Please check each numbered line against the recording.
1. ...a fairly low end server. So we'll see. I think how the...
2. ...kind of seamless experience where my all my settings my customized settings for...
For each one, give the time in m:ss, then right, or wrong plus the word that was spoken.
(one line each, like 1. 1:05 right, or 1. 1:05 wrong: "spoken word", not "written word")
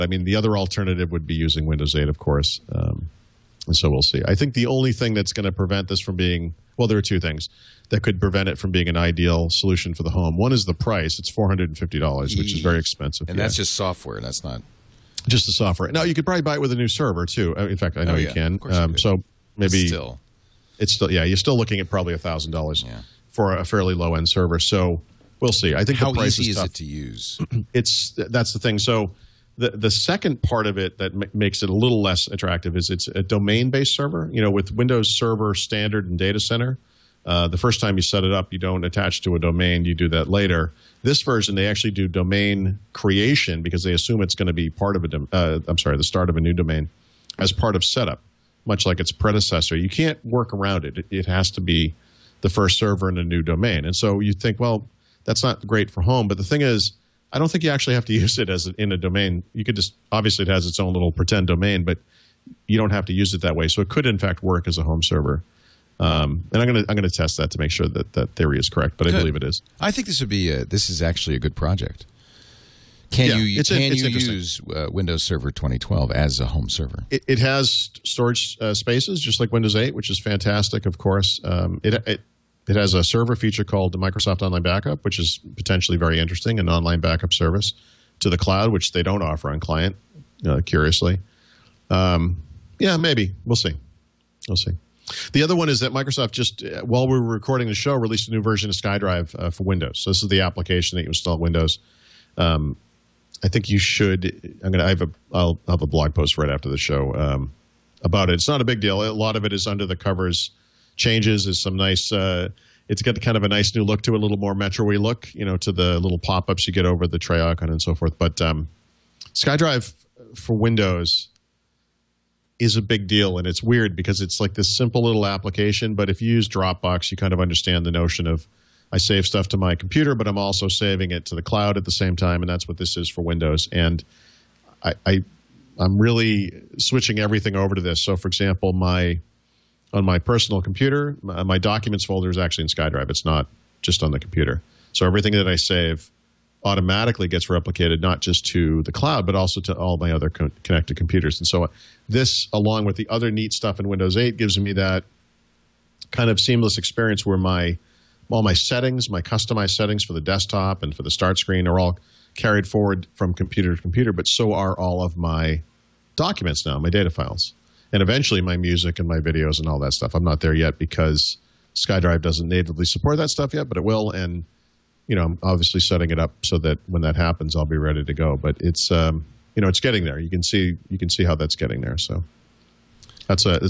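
1. 0:23 right
2. 2:36 right.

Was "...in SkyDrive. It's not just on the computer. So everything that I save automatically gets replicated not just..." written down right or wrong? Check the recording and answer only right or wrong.
right.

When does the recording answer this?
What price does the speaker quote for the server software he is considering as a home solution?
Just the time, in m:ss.
0:11.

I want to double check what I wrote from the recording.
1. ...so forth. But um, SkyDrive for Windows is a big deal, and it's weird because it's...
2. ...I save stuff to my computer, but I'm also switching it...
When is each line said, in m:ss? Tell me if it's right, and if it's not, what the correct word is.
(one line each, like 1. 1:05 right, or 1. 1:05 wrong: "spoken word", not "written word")
1. 1:57 right
2. 2:08 wrong: "saving", not "switching".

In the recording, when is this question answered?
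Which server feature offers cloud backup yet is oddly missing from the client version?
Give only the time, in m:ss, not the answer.
1:23.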